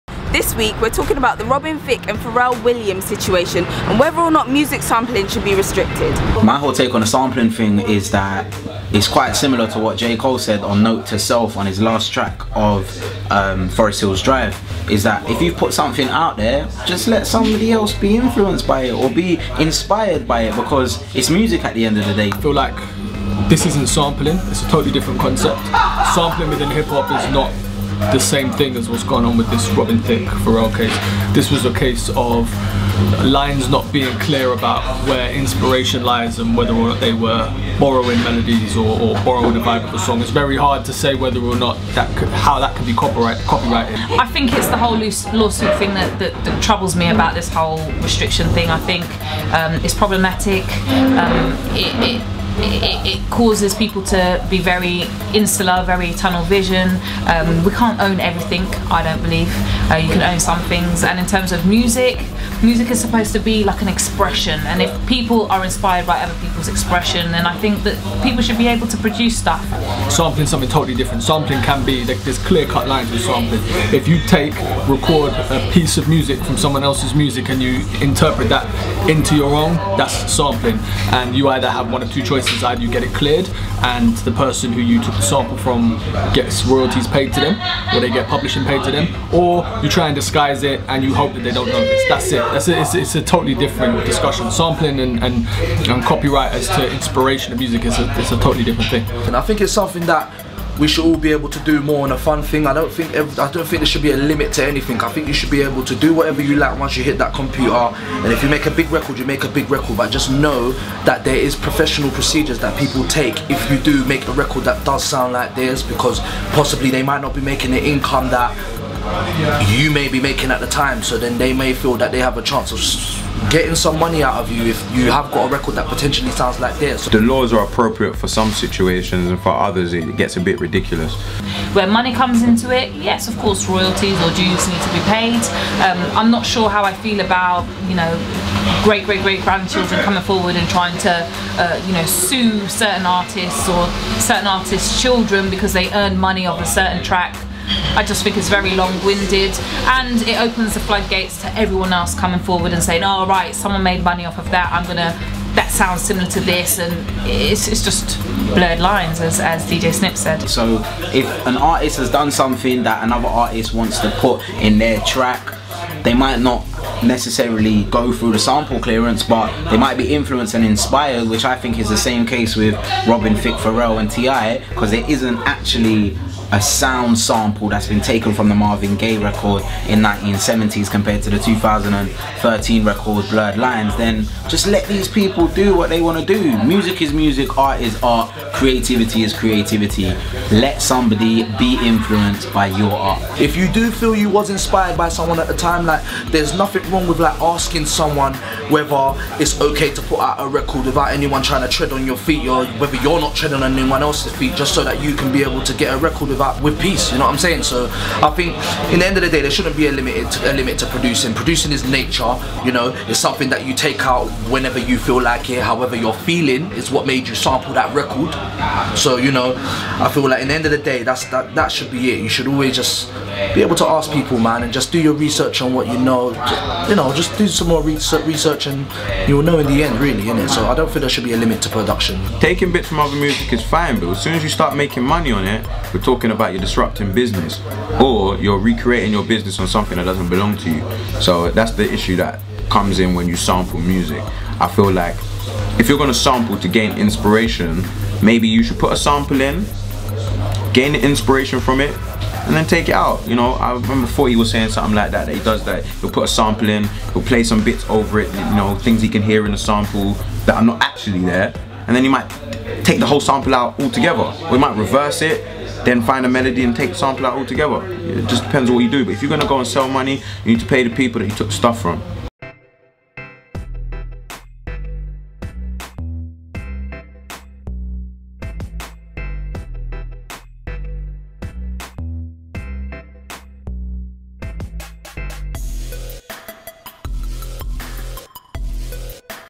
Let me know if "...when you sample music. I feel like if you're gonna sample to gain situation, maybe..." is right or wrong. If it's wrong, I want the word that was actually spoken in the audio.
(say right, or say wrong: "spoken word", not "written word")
wrong: "inspiration", not "situation".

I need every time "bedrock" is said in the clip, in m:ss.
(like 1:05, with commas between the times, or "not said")
not said.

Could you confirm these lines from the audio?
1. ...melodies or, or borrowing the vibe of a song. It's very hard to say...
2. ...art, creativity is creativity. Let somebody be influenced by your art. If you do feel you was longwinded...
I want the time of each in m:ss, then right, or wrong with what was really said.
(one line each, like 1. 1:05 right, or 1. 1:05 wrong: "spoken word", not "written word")
1. 0:38 right
2. 3:08 wrong: "inspired", not "longwinded".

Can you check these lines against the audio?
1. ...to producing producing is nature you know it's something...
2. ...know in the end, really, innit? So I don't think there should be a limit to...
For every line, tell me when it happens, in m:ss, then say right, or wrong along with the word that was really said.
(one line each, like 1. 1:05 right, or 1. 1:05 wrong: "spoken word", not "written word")
1. 3:30 right
2. 3:49 right.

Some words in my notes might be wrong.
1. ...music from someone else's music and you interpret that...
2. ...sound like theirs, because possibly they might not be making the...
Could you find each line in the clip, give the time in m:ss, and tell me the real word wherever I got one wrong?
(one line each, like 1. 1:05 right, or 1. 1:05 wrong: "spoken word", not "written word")
1. 1:16 right
2. 1:55 right.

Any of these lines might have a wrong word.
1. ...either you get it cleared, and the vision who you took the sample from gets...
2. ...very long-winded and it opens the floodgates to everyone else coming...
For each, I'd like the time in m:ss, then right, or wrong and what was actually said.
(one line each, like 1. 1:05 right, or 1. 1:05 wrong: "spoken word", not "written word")
1. 1:22 wrong: "person", not "vision"
2. 2:28 right.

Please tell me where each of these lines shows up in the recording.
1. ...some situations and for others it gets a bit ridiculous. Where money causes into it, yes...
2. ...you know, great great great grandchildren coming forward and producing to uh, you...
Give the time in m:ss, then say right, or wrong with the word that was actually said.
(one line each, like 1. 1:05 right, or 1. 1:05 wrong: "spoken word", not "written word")
1. 2:08 wrong: "comes", not "causes"
2. 2:17 wrong: "trying", not "producing".